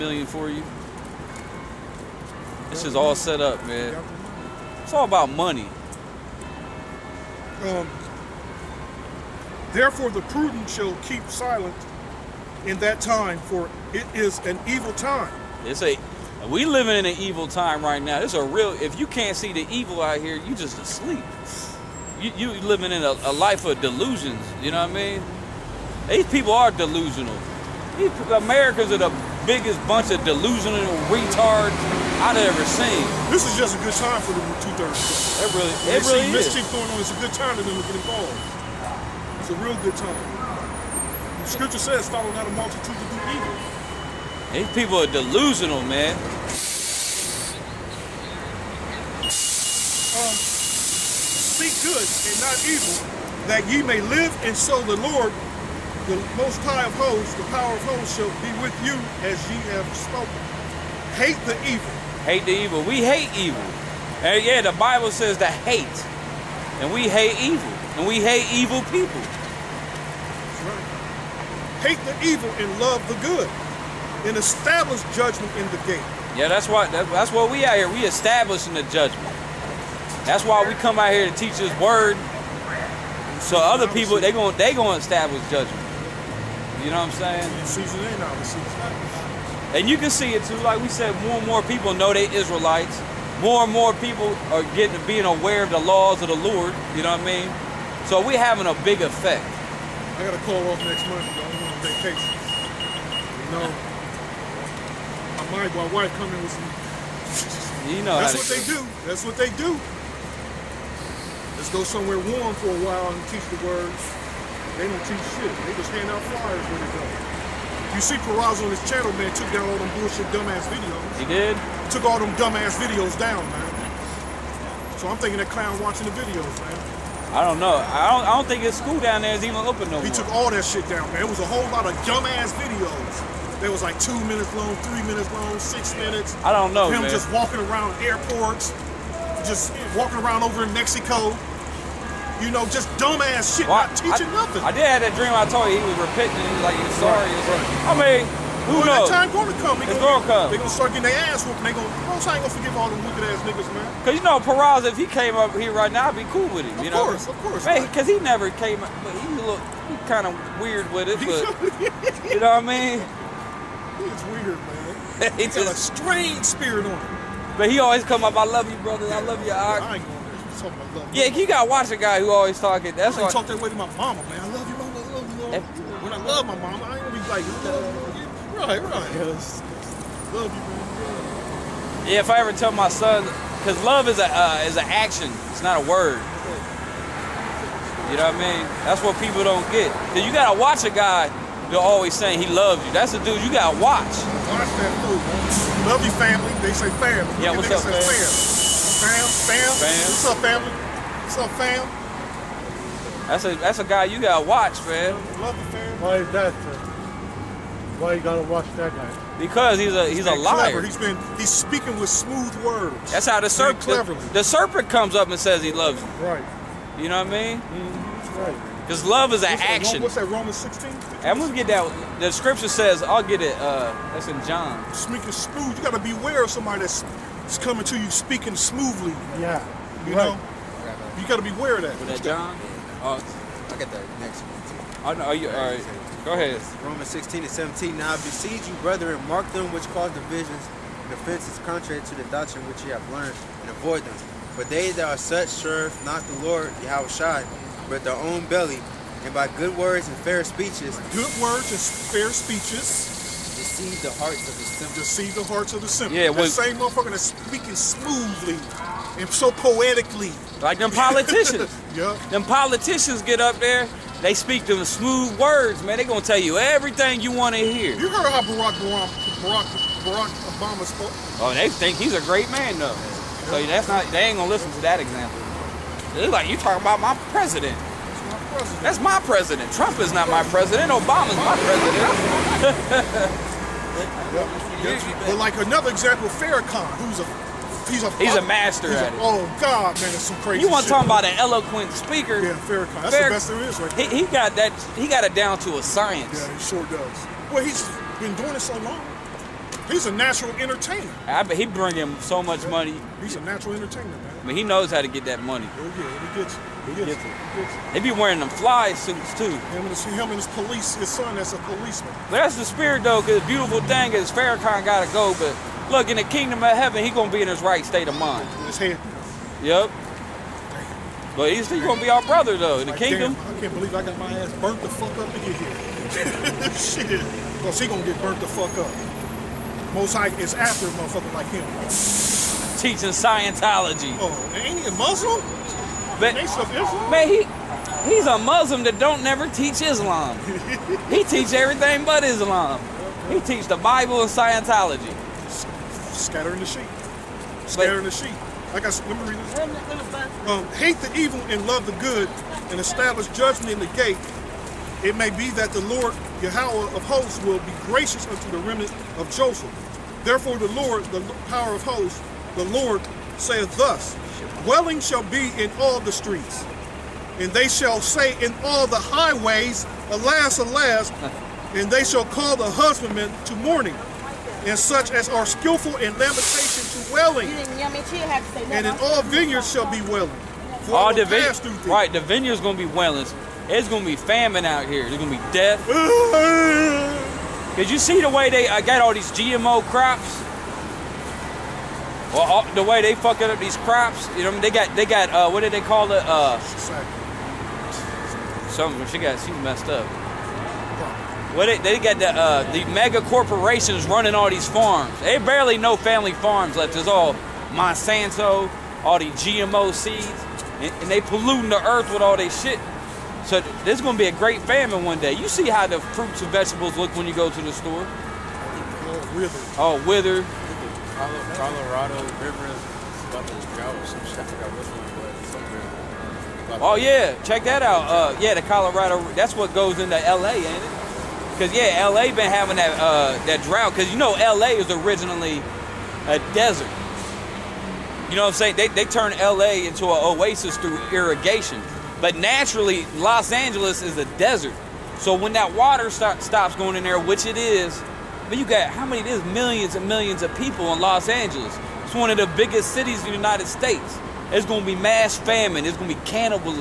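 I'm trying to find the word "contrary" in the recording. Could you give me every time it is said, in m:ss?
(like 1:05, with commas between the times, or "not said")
4:01.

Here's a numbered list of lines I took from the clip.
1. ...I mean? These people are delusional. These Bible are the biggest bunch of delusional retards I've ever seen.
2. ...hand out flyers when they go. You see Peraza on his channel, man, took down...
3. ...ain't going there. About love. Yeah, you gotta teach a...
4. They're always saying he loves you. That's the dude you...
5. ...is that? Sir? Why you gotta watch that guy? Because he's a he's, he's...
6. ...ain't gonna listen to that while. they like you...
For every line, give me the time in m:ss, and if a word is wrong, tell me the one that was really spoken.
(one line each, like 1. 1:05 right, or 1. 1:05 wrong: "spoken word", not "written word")
1. 0:24 wrong: "Americans", not "Bible"
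2. 1:55 right
3. 2:49 wrong: "watch", not "teach"
4. 3:11 right
5. 3:26 right
6. 4:34 wrong: "example", not "while".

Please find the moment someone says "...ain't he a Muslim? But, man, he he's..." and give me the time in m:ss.
5:34.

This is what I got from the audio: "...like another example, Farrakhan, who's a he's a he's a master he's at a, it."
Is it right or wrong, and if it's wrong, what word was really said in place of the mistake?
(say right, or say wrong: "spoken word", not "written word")
right.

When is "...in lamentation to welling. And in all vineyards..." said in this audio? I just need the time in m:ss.
6:15.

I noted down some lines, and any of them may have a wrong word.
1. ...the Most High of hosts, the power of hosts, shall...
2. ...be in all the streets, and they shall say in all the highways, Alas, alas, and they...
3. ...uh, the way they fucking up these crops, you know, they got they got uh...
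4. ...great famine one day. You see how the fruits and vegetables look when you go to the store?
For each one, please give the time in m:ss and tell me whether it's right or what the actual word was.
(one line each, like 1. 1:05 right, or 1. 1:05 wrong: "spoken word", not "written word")
1. 0:56 right
2. 6:05 right
3. 6:32 right
4. 6:54 right.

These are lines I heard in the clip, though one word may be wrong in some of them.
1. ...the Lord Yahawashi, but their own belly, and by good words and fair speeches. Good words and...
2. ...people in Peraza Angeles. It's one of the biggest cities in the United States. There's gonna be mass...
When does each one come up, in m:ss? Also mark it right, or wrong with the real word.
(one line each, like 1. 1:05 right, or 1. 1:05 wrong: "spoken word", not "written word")
1. 4:06 right
2. 7:30 wrong: "Los", not "Peraza".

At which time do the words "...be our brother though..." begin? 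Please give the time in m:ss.
5:22.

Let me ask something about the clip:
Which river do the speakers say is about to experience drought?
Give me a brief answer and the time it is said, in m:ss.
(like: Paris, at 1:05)
Colorado River, at 7:01.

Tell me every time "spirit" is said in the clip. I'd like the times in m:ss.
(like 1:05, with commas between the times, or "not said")
2:46, 5:12.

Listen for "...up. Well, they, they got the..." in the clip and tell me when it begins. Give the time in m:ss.
6:39.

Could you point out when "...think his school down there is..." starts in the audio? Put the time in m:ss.
2:08.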